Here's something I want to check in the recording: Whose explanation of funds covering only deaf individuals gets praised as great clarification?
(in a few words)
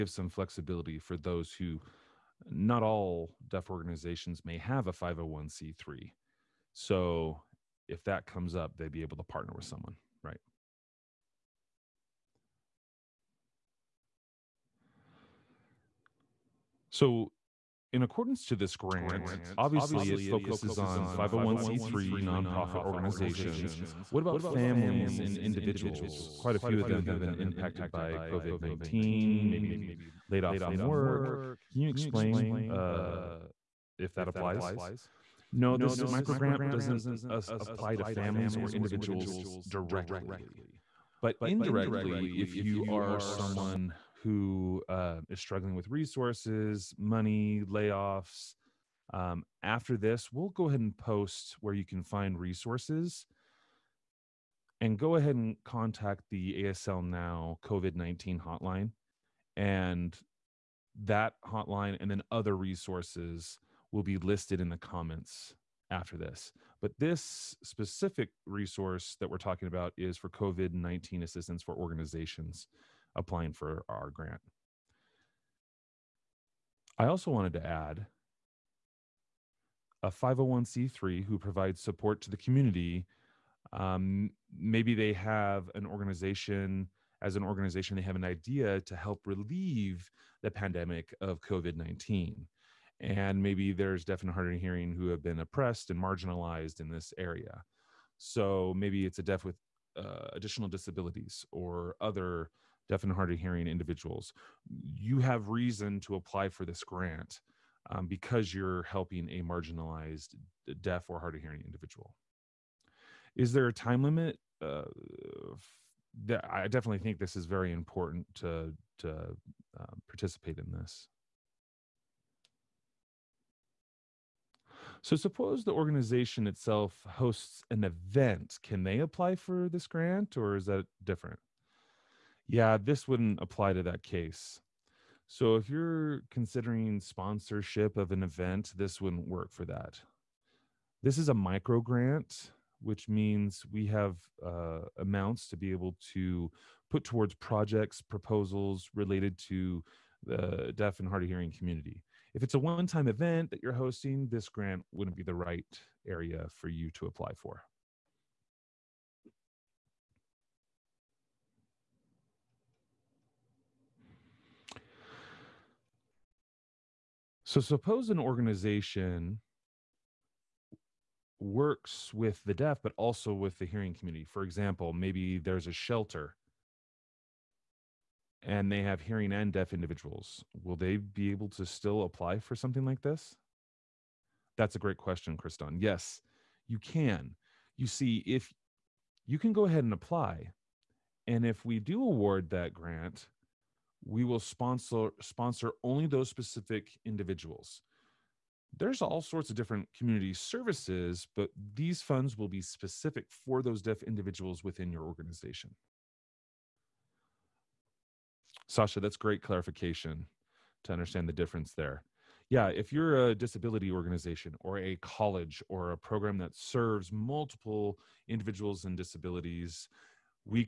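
Sasha.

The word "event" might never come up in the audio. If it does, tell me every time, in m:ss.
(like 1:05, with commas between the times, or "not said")
2:07, 2:18, 2:33.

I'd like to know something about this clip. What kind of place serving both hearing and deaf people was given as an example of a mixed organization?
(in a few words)
a shelter.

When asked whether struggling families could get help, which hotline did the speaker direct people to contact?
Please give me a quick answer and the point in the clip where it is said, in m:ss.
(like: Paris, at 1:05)
ASL Now COVID 19 hotline, at 0:56.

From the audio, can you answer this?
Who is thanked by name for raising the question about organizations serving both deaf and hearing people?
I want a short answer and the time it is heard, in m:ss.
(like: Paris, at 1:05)
Kriston, at 3:05.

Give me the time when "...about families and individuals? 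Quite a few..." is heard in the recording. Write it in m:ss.
0:24.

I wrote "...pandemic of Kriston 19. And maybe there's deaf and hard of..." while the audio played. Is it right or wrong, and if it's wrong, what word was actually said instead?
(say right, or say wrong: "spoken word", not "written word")
wrong: "COVID", not "Kriston".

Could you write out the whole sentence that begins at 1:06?
But this specific resource that we're talking about is for COVID 19 assistance for organizations applying for our grant.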